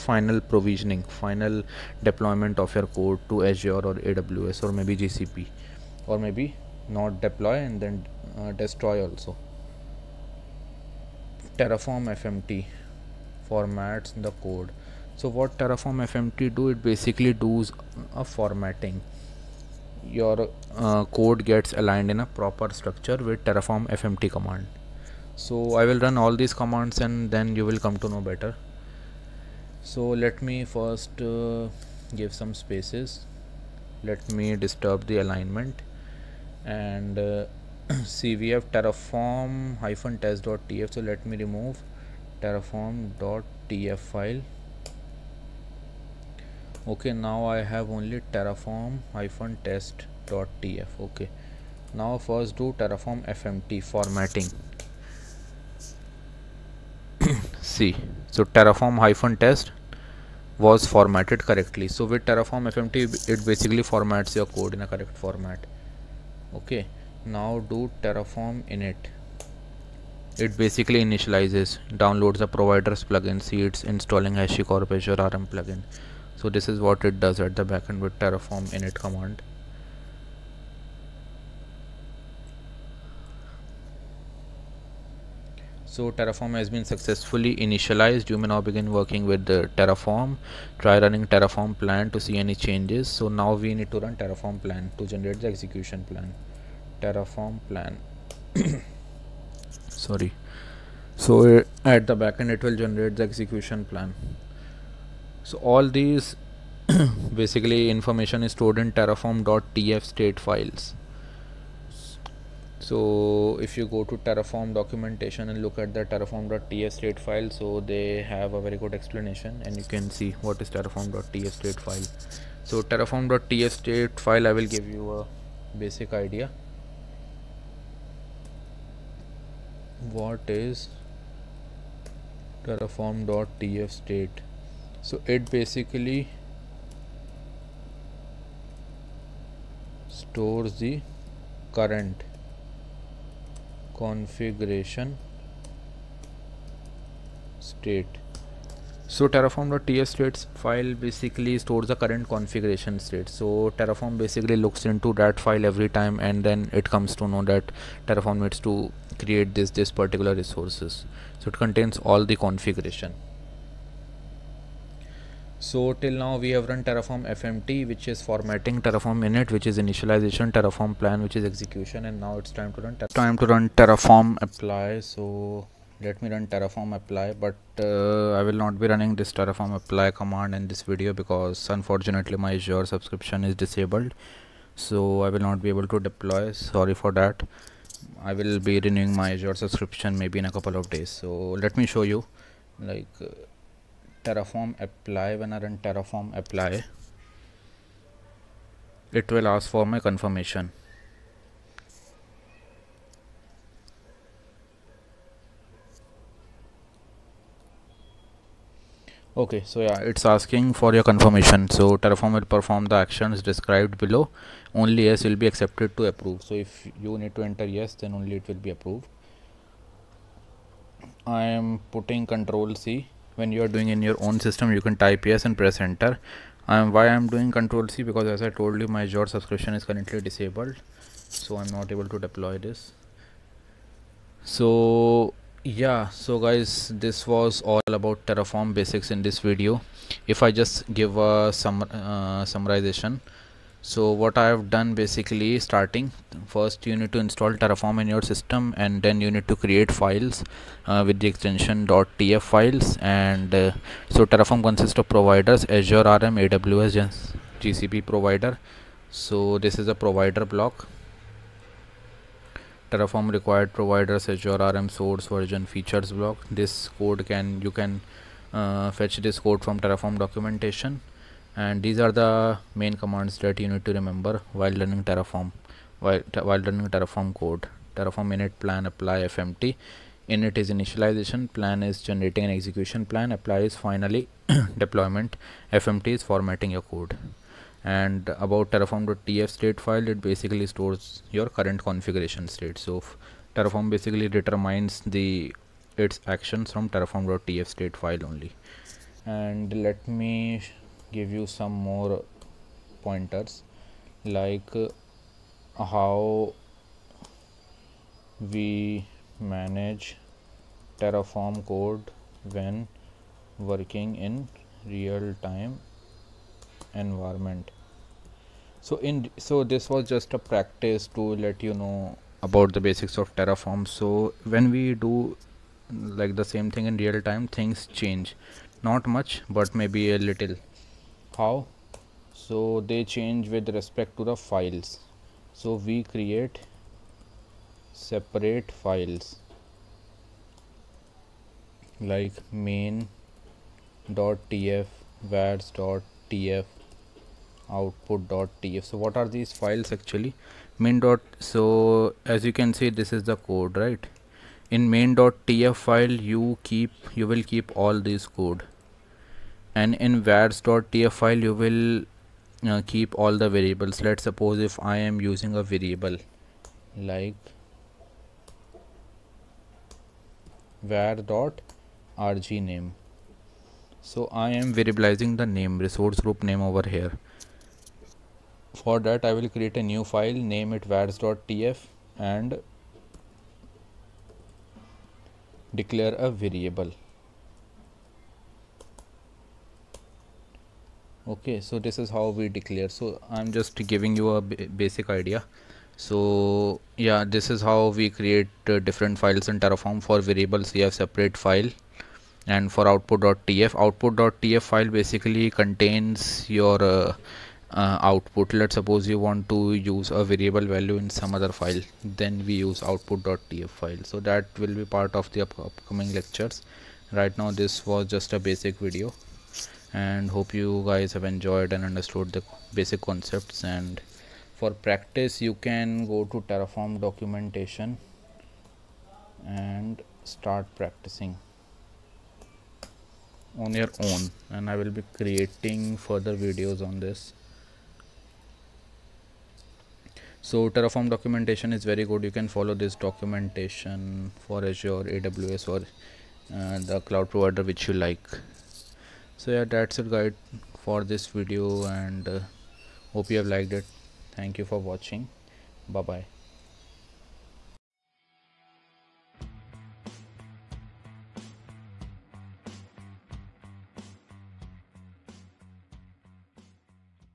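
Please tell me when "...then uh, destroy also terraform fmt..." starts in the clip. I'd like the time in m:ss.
0:07.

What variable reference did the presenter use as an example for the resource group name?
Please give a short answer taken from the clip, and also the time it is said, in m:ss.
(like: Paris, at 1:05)
var.rg name, at 6:10.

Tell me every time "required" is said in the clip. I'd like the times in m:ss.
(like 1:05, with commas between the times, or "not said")
4:23.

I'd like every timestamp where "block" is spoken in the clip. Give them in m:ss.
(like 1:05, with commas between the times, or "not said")
4:20, 4:26.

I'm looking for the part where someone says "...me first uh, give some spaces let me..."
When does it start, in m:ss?
0:30.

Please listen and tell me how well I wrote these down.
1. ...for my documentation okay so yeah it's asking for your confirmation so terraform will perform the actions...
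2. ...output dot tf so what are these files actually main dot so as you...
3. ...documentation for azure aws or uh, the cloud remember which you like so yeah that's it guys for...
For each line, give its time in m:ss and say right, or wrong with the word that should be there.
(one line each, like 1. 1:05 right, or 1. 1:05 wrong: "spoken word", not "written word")
1. 3:19 wrong: "confirmation", not "documentation"
2. 5:47 right
3. 7:22 wrong: "provider", not "remember".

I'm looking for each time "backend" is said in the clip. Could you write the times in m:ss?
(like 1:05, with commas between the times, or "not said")
1:17, 1:42.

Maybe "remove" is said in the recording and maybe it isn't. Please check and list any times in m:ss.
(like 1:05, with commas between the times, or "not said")
0:41.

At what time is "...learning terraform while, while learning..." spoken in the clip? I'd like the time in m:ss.
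4:34.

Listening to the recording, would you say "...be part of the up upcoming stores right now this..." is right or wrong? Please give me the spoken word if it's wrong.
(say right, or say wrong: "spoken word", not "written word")
wrong: "lectures", not "stores".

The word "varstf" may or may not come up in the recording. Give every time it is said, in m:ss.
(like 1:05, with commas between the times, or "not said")
6:00, 6:20.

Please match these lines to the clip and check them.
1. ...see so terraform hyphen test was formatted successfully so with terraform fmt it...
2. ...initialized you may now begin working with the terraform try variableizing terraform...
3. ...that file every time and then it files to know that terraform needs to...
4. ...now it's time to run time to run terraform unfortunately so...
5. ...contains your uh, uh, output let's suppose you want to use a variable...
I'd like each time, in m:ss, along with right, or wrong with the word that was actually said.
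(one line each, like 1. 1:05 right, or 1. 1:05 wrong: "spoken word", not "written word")
1. 0:57 wrong: "correctly", not "successfully"
2. 1:27 wrong: "running", not "variableizing"
3. 2:35 wrong: "comes", not "files"
4. 2:52 wrong: "apply", not "unfortunately"
5. 6:45 right.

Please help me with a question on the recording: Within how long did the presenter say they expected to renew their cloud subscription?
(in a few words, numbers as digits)
a couple of days.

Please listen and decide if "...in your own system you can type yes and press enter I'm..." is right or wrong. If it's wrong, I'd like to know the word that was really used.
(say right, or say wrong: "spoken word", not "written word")
right.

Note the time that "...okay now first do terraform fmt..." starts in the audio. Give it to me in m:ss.
0:51.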